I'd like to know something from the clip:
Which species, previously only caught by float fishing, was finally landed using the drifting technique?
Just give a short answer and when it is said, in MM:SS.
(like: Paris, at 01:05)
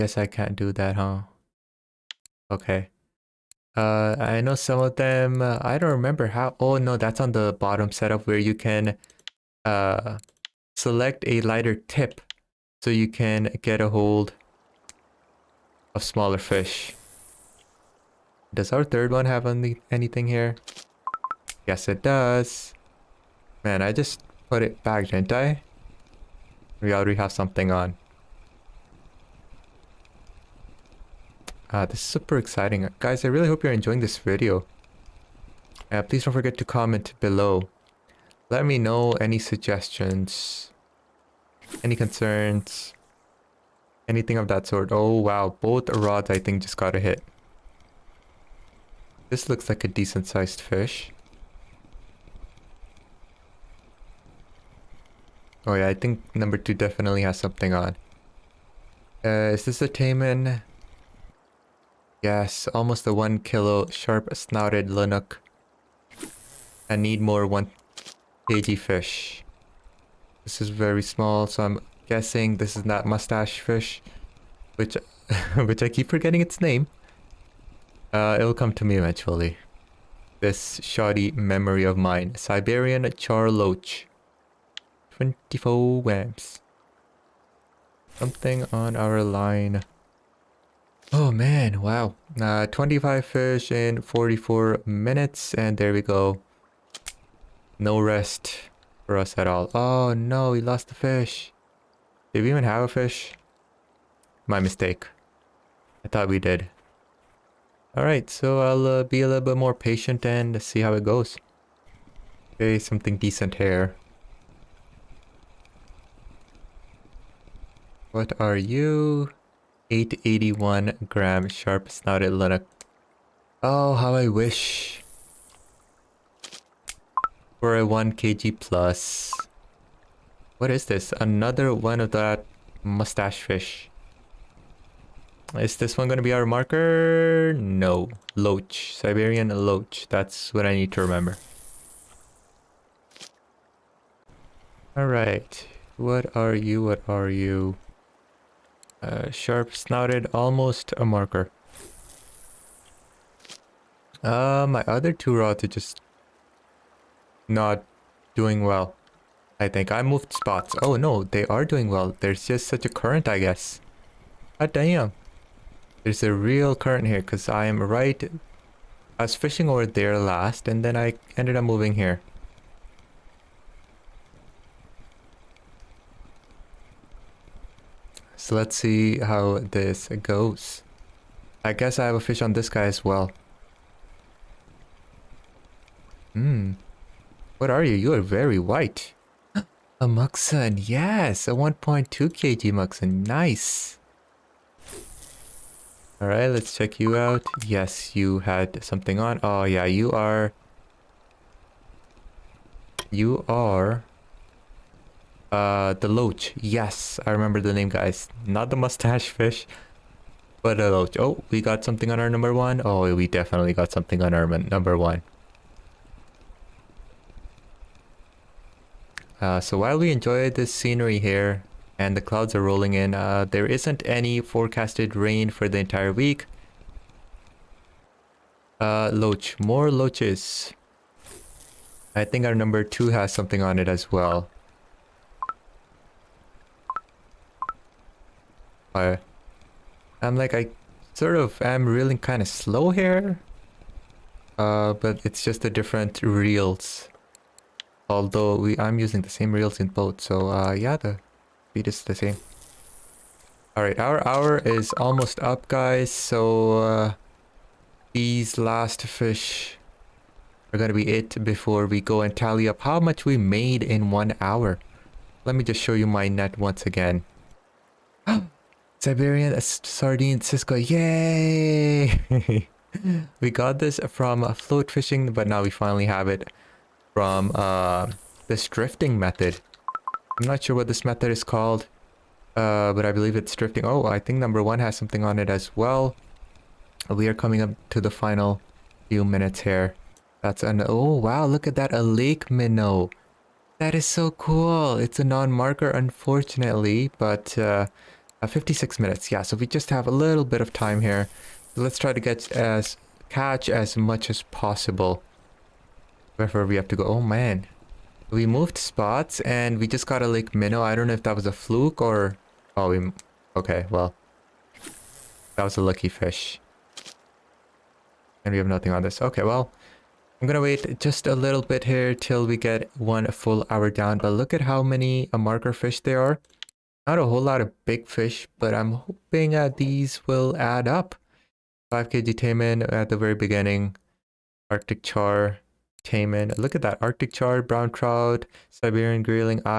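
Siberian sardine Cisco, at 04:28.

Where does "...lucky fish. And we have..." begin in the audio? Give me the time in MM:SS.
05:15.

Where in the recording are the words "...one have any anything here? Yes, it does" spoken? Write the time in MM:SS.
00:19.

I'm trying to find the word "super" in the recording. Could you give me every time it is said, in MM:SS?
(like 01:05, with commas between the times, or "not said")
00:32.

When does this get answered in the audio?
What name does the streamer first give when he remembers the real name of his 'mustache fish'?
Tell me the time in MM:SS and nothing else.
01:22.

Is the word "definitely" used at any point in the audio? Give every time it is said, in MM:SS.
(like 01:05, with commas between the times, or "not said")
00:56, 03:33.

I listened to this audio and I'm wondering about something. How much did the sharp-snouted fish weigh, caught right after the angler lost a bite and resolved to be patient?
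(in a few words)
881 grams.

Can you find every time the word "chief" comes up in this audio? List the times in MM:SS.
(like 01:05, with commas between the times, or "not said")
not said.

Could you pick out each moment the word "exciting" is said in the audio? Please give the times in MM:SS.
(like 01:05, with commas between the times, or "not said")
00:32.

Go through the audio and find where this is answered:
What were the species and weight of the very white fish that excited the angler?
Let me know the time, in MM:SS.
03:11.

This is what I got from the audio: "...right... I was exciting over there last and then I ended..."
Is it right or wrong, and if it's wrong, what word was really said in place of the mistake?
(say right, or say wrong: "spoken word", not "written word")
wrong: "fishing", not "exciting".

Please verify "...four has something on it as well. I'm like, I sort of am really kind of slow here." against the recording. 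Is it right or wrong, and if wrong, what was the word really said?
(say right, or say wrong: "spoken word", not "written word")
wrong: "two", not "four".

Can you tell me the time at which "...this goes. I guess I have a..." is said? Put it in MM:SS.
02:59.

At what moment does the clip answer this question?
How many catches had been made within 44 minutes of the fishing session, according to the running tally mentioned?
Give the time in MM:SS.
01:32.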